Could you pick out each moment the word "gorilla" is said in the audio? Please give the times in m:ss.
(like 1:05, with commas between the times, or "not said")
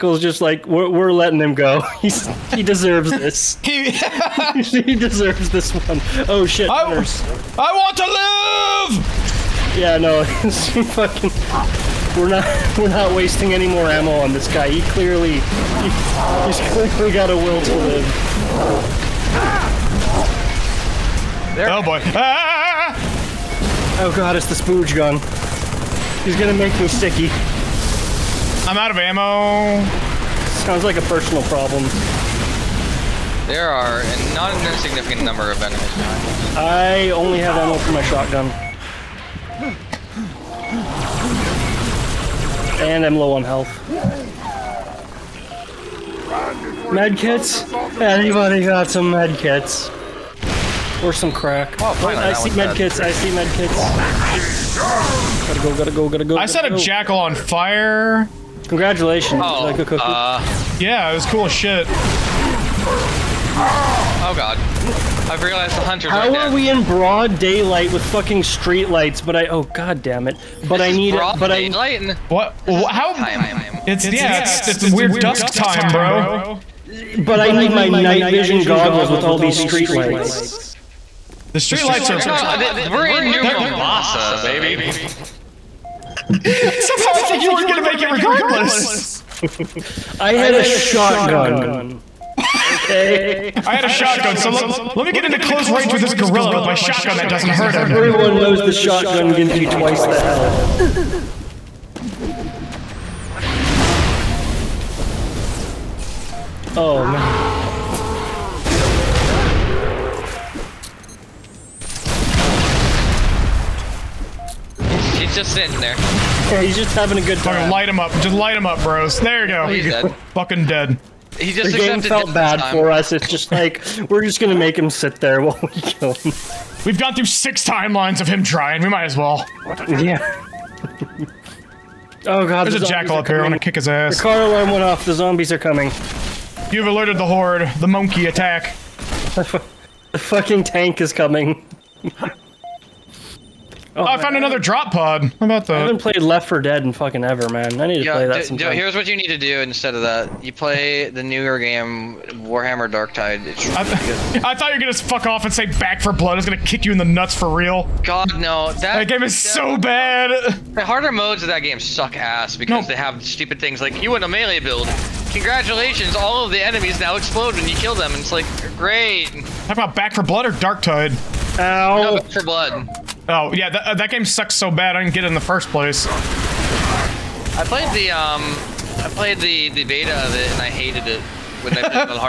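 1:36.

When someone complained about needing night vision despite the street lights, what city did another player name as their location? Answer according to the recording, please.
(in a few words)
Mombasa.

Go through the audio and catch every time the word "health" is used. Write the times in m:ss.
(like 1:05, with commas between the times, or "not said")
0:43, 1:40.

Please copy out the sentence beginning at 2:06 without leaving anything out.
We've gone through six timelines of him trying.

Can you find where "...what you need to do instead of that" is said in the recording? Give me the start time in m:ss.
2:28.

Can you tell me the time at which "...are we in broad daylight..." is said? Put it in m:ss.
1:06.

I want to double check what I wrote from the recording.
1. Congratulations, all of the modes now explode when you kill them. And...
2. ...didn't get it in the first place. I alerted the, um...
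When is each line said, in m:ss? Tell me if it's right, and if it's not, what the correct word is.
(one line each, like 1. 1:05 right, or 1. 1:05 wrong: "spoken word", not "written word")
1. 2:45 wrong: "enemies", not "modes"
2. 2:55 wrong: "played", not "alerted".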